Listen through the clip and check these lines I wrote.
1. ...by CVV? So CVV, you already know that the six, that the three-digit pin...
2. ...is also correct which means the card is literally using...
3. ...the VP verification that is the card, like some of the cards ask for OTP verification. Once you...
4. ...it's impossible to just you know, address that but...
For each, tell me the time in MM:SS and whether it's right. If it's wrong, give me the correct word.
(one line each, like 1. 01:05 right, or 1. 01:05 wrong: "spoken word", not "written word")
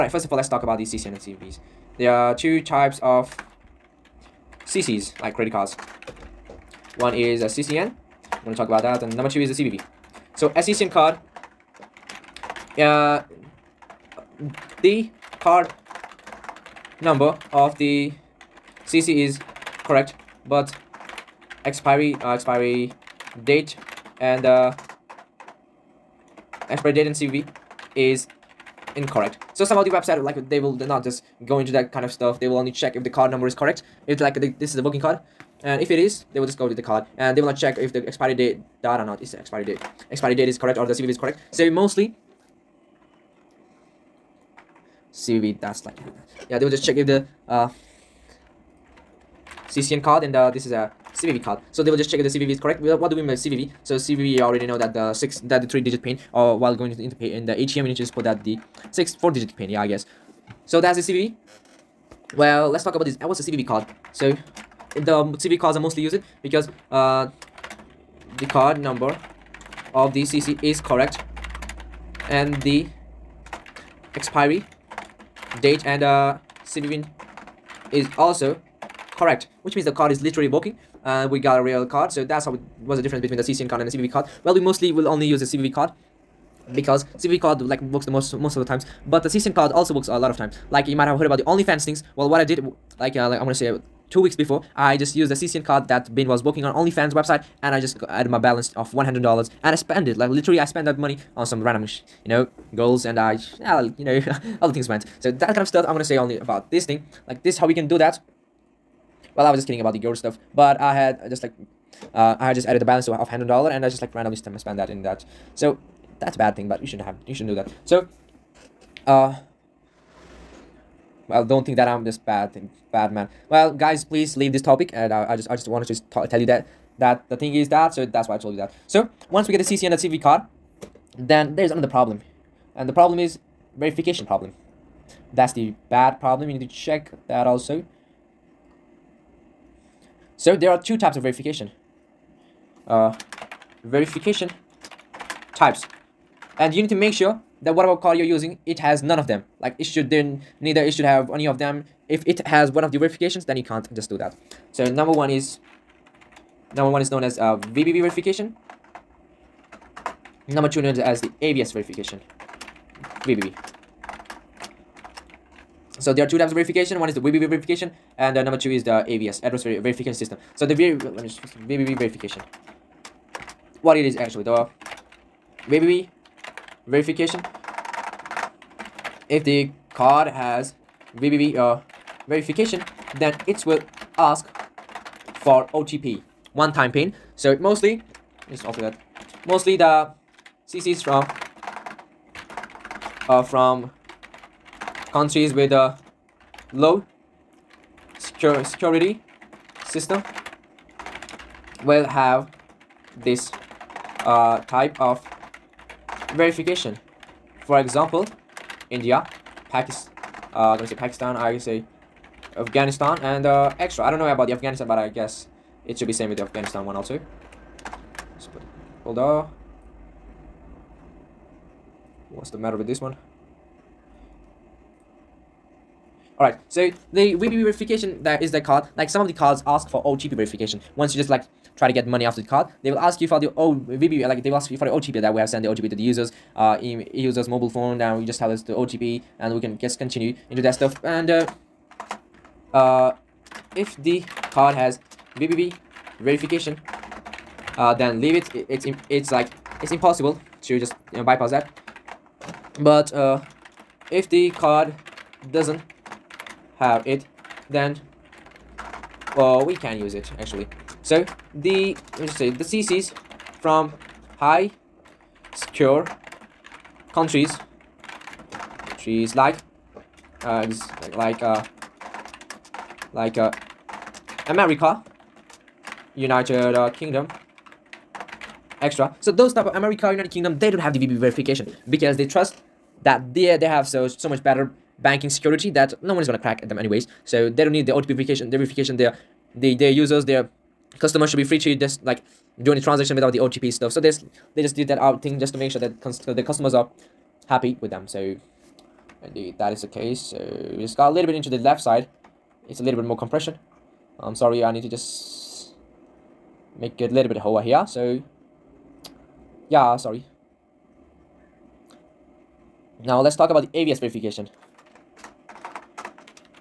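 1. 00:53 right
2. 01:17 wrong: "working", not "using"
3. 03:47 right
4. 04:09 wrong: "bypass", not "address".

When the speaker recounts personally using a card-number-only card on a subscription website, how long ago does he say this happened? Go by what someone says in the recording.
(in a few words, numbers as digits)
two weeks.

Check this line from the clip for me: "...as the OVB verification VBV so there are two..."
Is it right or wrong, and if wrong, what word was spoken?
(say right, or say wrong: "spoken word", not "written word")
wrong: "AVS", not "OVB".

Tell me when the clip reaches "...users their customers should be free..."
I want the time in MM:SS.
04:49.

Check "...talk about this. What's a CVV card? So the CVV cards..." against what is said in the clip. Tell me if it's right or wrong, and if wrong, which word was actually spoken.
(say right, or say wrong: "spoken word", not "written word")
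right.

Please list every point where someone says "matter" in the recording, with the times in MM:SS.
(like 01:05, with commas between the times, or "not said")
03:42.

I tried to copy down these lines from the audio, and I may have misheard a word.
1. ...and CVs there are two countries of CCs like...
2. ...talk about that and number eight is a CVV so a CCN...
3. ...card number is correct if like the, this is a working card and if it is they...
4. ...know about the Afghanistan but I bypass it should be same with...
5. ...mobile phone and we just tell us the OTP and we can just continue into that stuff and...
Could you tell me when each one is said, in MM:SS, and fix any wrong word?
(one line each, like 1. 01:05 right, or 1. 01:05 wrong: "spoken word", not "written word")
1. 00:01 wrong: "types", not "countries"
2. 00:08 wrong: "two", not "eight"
3. 00:33 right
4. 03:34 wrong: "guess", not "bypass"
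5. 03:57 right.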